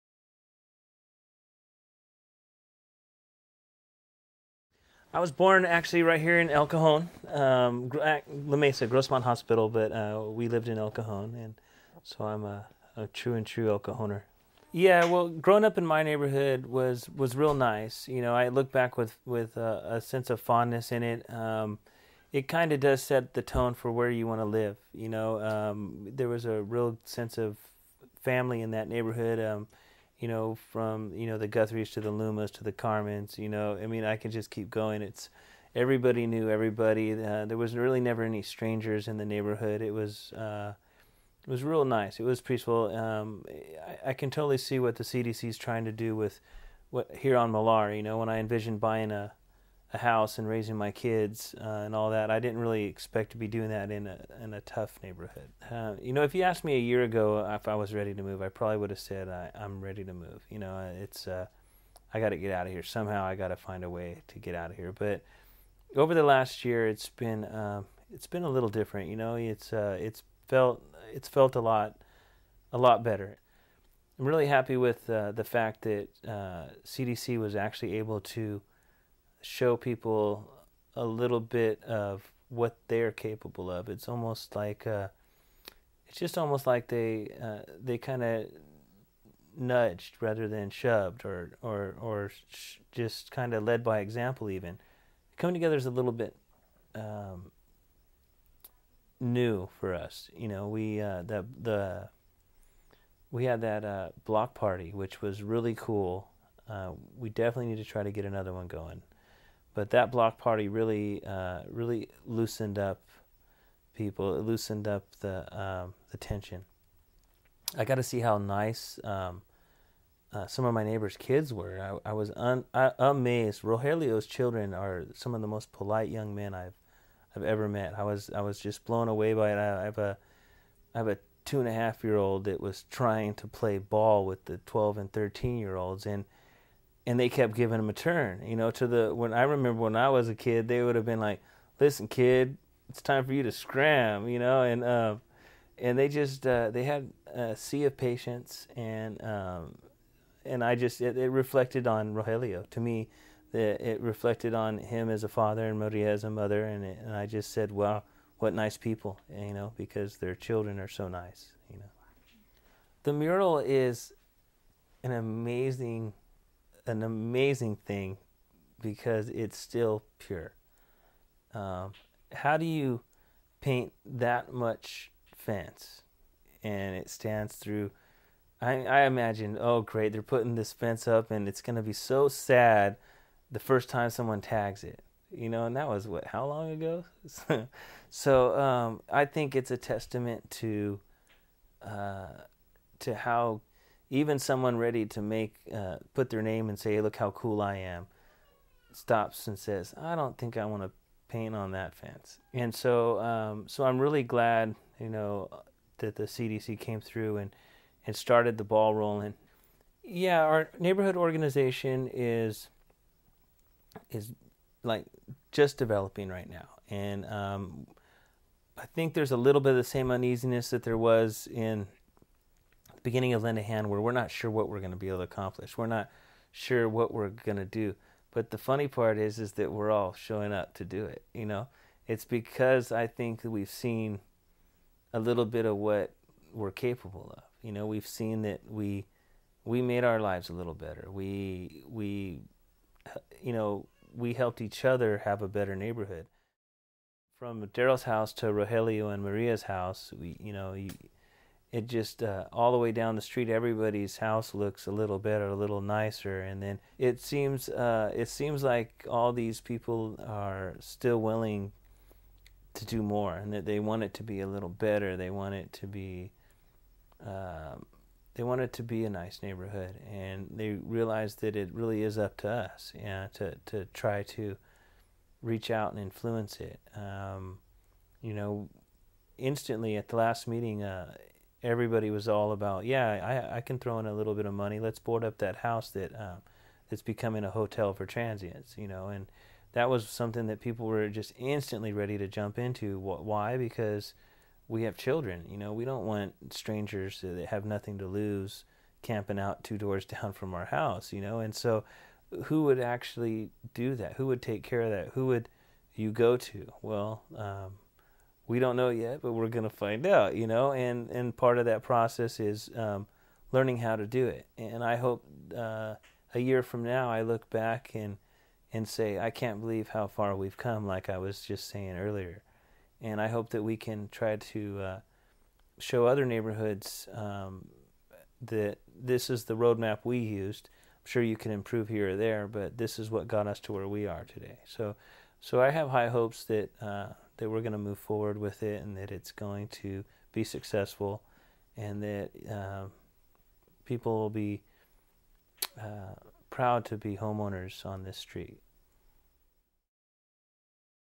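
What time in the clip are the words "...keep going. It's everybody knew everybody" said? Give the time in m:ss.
0:34.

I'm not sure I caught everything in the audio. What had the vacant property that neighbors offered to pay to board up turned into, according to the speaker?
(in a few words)
a hotel for transients.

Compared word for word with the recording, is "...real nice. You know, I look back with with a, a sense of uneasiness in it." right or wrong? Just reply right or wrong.
wrong.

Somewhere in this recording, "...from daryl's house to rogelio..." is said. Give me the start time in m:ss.
4:07.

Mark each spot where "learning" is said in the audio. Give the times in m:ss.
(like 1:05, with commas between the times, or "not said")
5:13.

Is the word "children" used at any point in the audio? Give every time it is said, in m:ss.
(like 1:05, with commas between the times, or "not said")
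2:04, 2:40, 4:54.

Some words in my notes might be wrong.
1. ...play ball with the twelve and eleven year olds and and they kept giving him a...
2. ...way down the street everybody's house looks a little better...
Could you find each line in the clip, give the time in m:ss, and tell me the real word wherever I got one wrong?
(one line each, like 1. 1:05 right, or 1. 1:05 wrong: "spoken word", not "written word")
1. 2:13 wrong: "thirteen", not "eleven"
2. 4:12 right.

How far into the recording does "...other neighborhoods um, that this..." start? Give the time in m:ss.
5:26.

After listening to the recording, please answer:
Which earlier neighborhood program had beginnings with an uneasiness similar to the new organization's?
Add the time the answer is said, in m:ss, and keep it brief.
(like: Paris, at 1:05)
Lend a Hand, at 3:43.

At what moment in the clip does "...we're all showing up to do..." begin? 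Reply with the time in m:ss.
3:49.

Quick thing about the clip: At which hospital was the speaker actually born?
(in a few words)
Grossmont Hospital.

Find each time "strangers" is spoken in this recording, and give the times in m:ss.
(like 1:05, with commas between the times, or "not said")
0:38, 4:56.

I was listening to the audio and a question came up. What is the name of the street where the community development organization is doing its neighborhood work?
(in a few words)
Millar.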